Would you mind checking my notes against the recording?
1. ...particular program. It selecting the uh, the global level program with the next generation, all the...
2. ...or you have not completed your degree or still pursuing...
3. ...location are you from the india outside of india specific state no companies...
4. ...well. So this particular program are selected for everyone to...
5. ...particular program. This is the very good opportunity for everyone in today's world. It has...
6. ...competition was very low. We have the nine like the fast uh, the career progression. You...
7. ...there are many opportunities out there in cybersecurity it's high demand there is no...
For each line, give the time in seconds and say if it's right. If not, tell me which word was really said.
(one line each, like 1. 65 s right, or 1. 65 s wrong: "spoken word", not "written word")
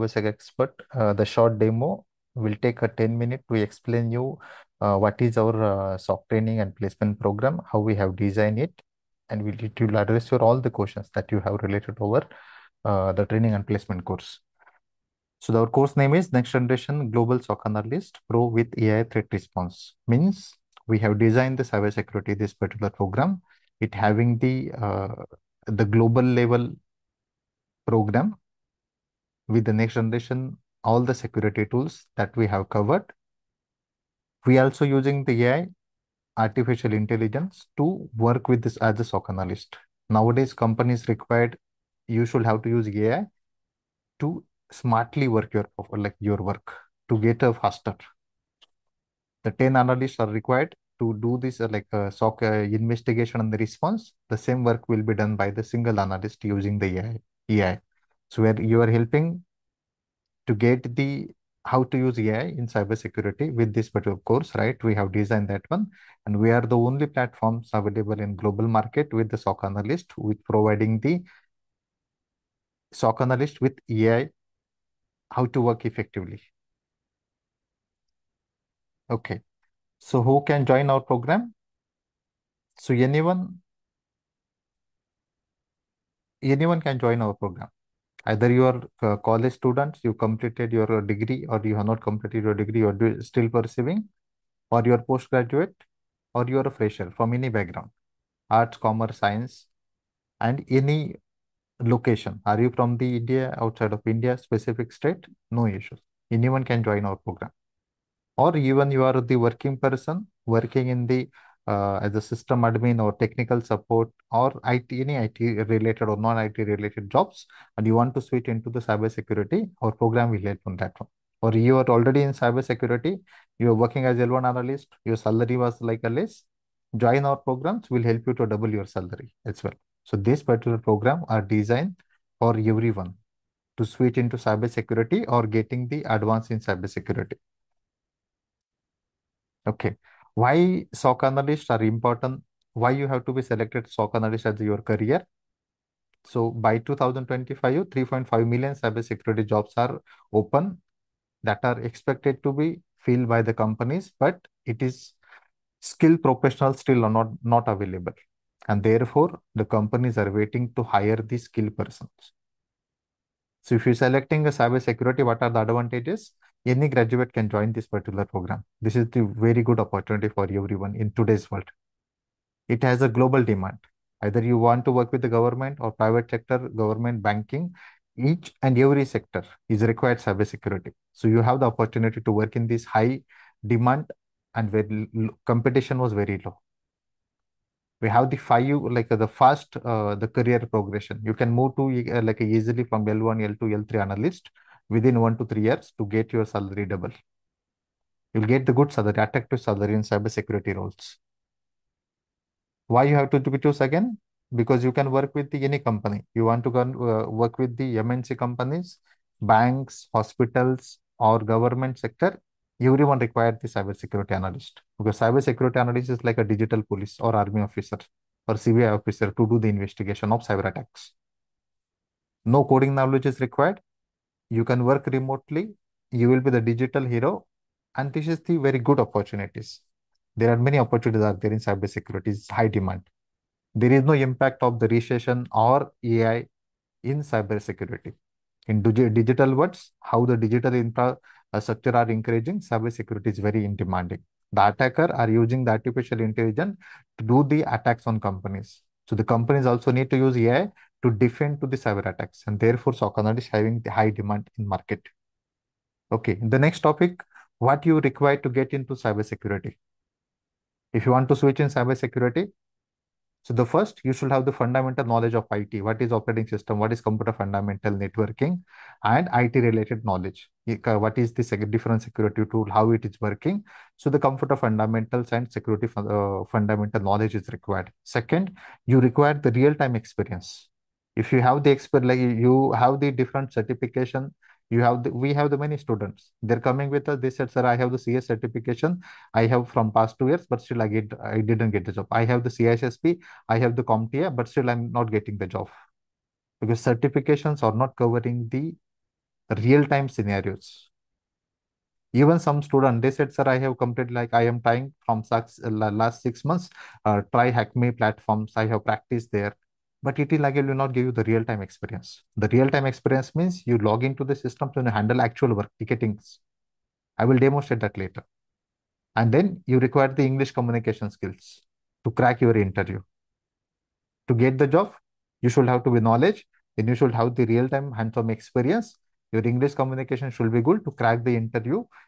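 1. 22 s wrong: "having", not "selecting"
2. 91 s right
3. 101 s wrong: "issues", not "companies"
4. 129 s wrong: "designed", not "selected"
5. 167 s right
6. 185 s wrong: "five", not "nine"
7. 230 s right.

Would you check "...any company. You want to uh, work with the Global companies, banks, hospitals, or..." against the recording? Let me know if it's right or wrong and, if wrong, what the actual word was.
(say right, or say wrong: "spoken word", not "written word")
wrong: "MNC", not "Global".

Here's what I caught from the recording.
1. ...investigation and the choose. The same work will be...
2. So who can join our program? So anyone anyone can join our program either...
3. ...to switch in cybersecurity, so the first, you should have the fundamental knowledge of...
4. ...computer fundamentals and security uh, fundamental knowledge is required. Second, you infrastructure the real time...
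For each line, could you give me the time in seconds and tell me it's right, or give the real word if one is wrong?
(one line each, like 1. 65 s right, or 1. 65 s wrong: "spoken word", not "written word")
1. 52 s wrong: "response", not "choose"
2. 79 s right
3. 261 s right
4. 274 s wrong: "require", not "infrastructure".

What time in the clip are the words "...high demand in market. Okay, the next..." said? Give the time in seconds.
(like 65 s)
253 s.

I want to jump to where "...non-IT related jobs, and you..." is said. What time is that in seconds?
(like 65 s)
116 s.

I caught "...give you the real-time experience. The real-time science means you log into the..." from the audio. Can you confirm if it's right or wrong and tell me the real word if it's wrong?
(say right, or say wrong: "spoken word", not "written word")
wrong: "experience", not "science".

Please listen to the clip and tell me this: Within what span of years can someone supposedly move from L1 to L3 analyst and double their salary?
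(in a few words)
1 to 3 years.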